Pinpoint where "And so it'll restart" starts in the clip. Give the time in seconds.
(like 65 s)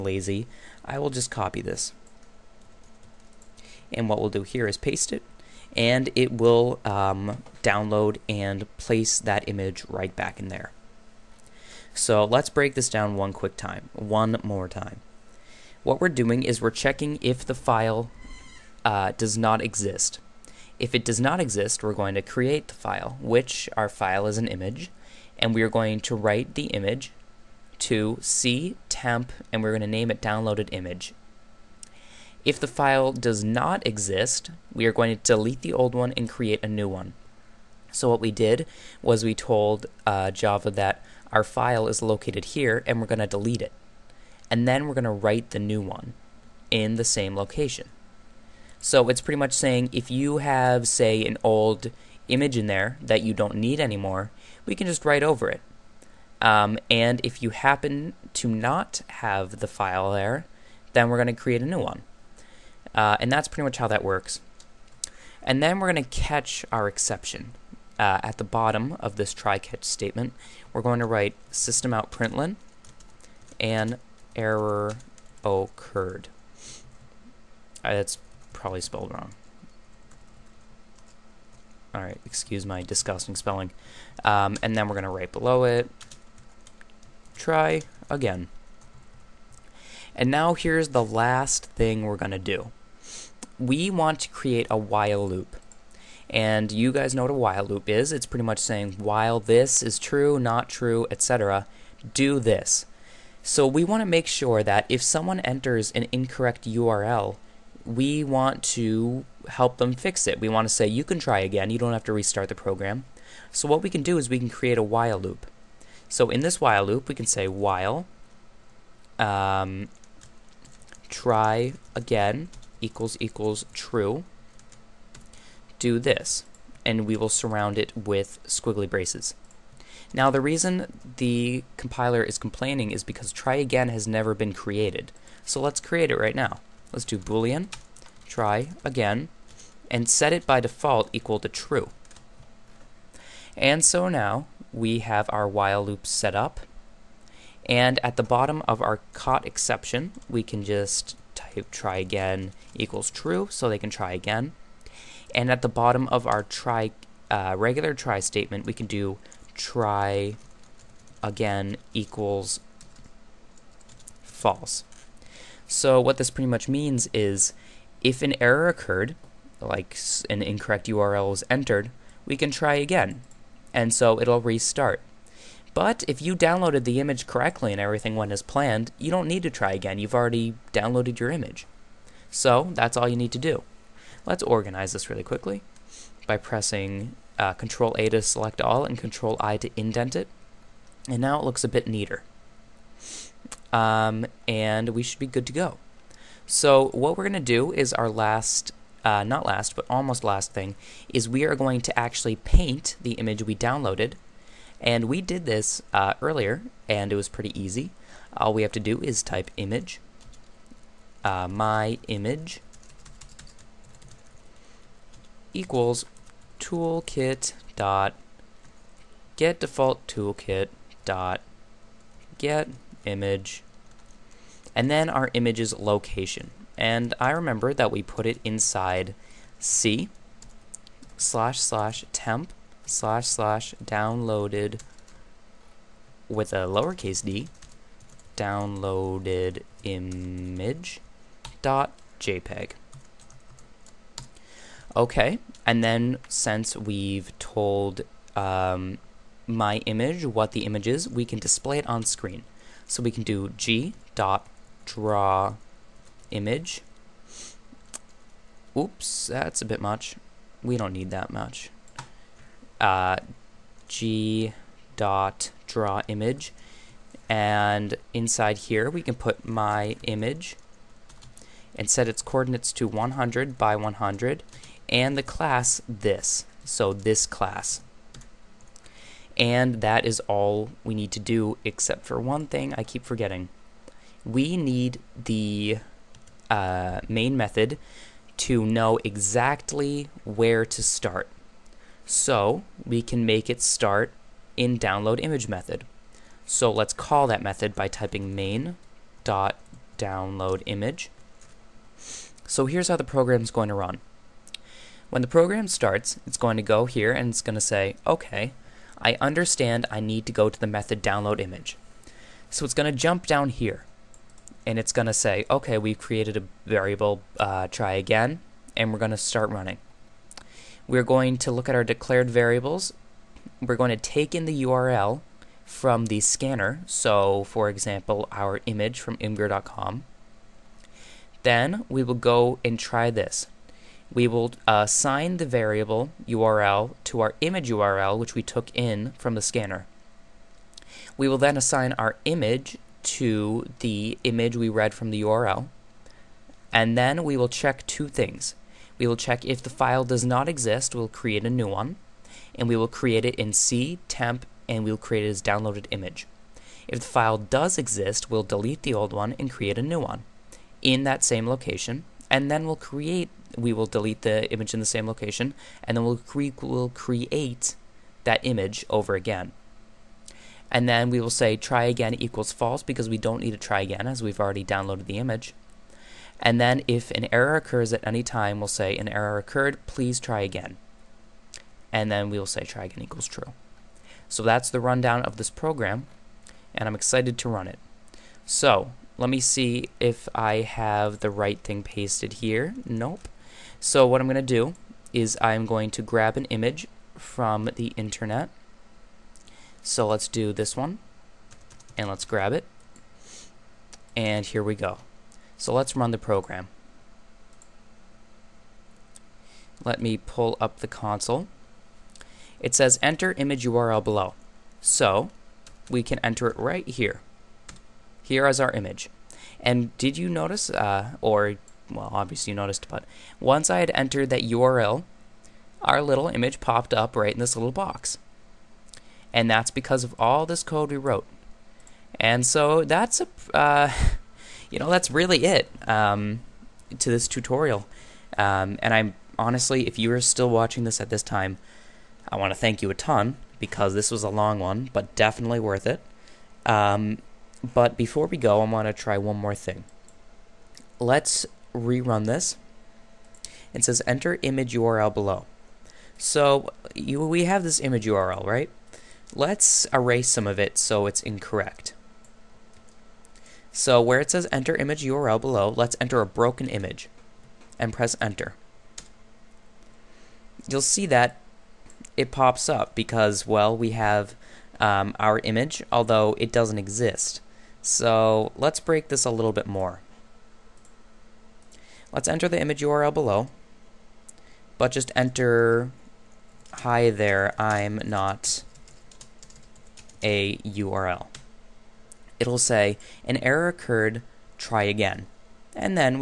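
173 s.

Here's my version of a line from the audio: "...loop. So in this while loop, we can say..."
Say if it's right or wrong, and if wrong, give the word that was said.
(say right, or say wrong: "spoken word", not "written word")
right.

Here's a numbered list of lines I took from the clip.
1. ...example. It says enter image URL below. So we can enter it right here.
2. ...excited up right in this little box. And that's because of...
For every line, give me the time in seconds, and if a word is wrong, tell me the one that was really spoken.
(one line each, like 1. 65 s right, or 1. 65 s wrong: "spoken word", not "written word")
1. 410 s wrong: "console", not "example"
2. 426 s wrong: "popped", not "excited".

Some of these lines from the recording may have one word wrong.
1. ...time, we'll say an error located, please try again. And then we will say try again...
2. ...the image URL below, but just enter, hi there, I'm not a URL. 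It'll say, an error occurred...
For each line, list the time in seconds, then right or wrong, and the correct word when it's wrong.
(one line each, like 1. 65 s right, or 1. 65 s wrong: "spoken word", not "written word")
1. 378 s wrong: "occurred", not "located"
2. 482 s right.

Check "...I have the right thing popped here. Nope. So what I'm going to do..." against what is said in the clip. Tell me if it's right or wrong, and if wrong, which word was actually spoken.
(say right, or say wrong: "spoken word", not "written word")
wrong: "pasted", not "popped".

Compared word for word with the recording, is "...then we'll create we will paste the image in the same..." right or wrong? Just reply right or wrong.
wrong.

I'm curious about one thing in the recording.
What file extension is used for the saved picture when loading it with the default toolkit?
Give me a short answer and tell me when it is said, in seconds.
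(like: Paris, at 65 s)
jpeg, at 242 s.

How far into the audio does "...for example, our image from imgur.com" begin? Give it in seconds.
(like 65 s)
327 s.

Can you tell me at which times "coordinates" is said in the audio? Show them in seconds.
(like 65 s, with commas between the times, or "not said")
272 s.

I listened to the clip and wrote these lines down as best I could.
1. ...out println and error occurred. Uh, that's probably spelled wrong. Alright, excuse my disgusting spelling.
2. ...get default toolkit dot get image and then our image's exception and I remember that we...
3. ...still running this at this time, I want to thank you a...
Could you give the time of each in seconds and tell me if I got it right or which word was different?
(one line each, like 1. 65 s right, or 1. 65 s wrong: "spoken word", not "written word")
1. 71 s right
2. 219 s wrong: "location", not "exception"
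3. 440 s wrong: "watching", not "running".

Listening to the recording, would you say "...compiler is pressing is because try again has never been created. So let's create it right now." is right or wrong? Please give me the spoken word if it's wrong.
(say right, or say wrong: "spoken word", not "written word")
wrong: "complaining", not "pressing".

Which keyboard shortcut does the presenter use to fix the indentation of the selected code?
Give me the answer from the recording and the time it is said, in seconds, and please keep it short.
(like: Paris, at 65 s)
Control I, at 188 s.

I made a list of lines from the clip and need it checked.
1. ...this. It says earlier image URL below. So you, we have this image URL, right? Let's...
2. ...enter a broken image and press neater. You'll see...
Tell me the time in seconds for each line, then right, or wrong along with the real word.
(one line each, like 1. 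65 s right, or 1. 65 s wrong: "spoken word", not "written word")
1. 452 s wrong: "enter", not "earlier"
2. 465 s wrong: "enter", not "neater".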